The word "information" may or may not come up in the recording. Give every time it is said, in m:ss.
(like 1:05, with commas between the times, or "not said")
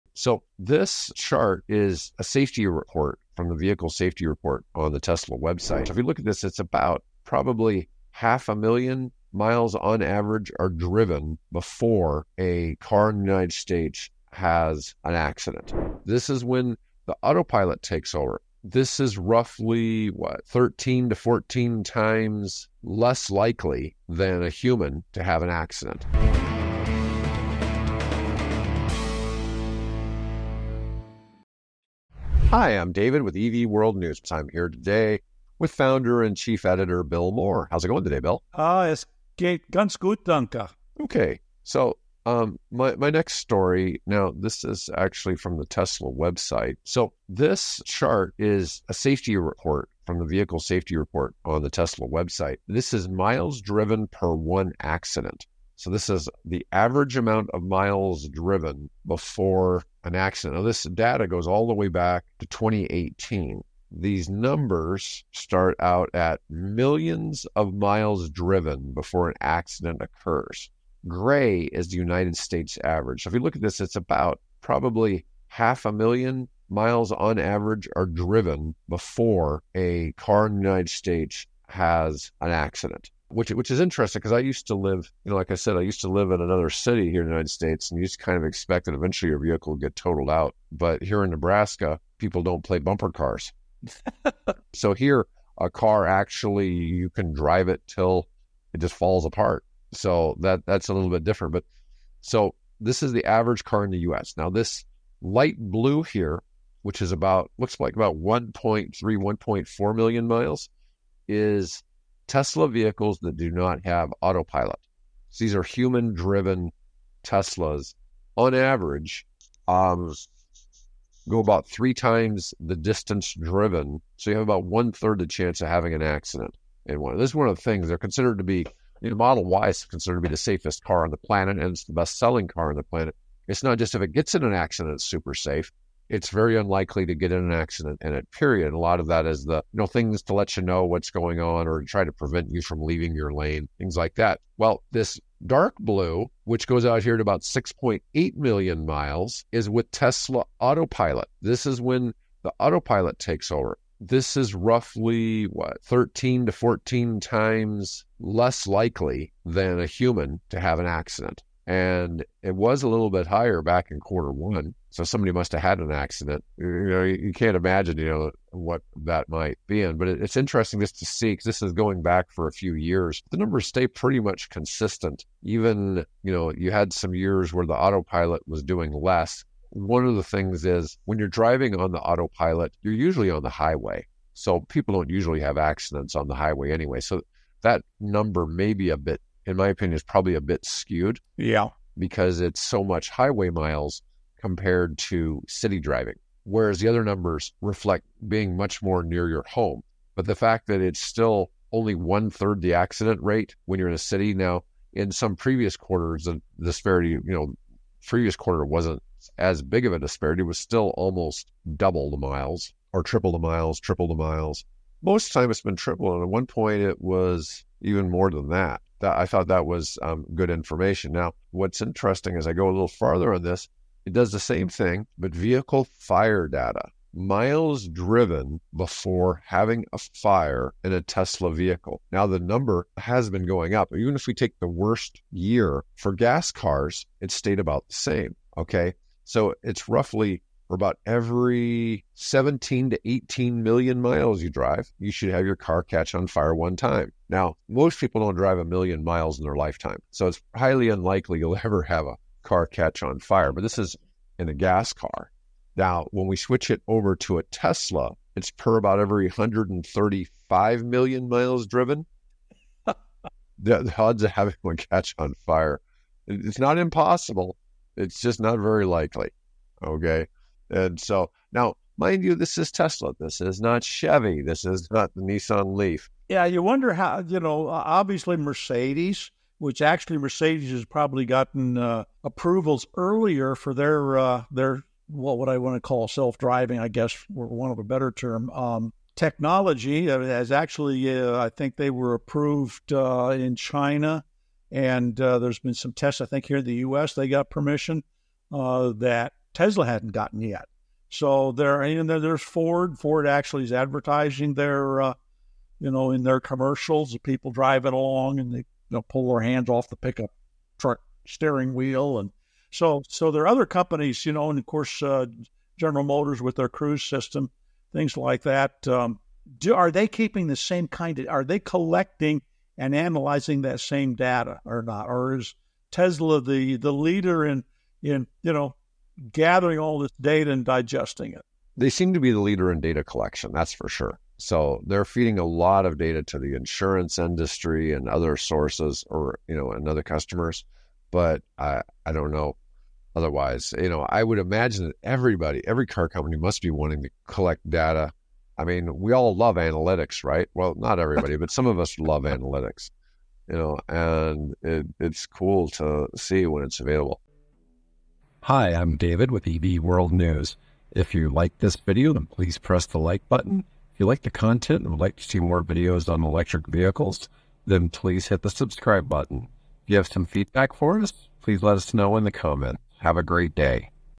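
3:40.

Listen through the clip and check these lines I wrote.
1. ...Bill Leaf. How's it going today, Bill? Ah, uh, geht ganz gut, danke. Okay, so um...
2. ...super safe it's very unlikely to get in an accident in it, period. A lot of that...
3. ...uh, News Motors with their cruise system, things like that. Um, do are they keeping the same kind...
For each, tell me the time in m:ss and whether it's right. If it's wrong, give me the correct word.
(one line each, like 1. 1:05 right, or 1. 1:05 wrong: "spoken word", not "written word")
1. 0:37 wrong: "Moore", not "Leaf"
2. 2:15 right
3. 5:15 wrong: "General", not "News".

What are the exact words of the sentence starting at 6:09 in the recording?
If you have some feedback for us, please let us know in the comments.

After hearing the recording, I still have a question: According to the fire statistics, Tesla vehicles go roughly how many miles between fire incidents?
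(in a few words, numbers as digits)
135 million miles.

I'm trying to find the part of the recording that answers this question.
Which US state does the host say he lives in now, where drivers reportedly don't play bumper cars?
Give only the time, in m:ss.
1:31.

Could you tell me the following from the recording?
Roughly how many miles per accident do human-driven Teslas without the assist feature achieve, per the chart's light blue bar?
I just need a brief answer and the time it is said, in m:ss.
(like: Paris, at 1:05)
1.3 to 1.4 million, at 1:48.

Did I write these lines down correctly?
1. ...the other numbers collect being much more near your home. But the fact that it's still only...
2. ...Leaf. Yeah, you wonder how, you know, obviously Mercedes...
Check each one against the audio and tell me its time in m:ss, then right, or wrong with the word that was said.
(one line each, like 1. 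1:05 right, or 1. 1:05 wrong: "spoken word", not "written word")
1. 3:16 wrong: "reflect", not "collect"
2. 4:35 right.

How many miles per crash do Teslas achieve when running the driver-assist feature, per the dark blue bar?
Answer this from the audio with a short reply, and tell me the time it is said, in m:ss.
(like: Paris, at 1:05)
6.8 million miles, at 2:27.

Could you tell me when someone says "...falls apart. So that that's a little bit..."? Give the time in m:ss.
1:38.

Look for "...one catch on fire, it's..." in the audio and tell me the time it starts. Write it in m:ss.
4:24.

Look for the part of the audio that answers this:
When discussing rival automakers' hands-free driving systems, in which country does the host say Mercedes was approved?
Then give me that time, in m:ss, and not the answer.
4:53.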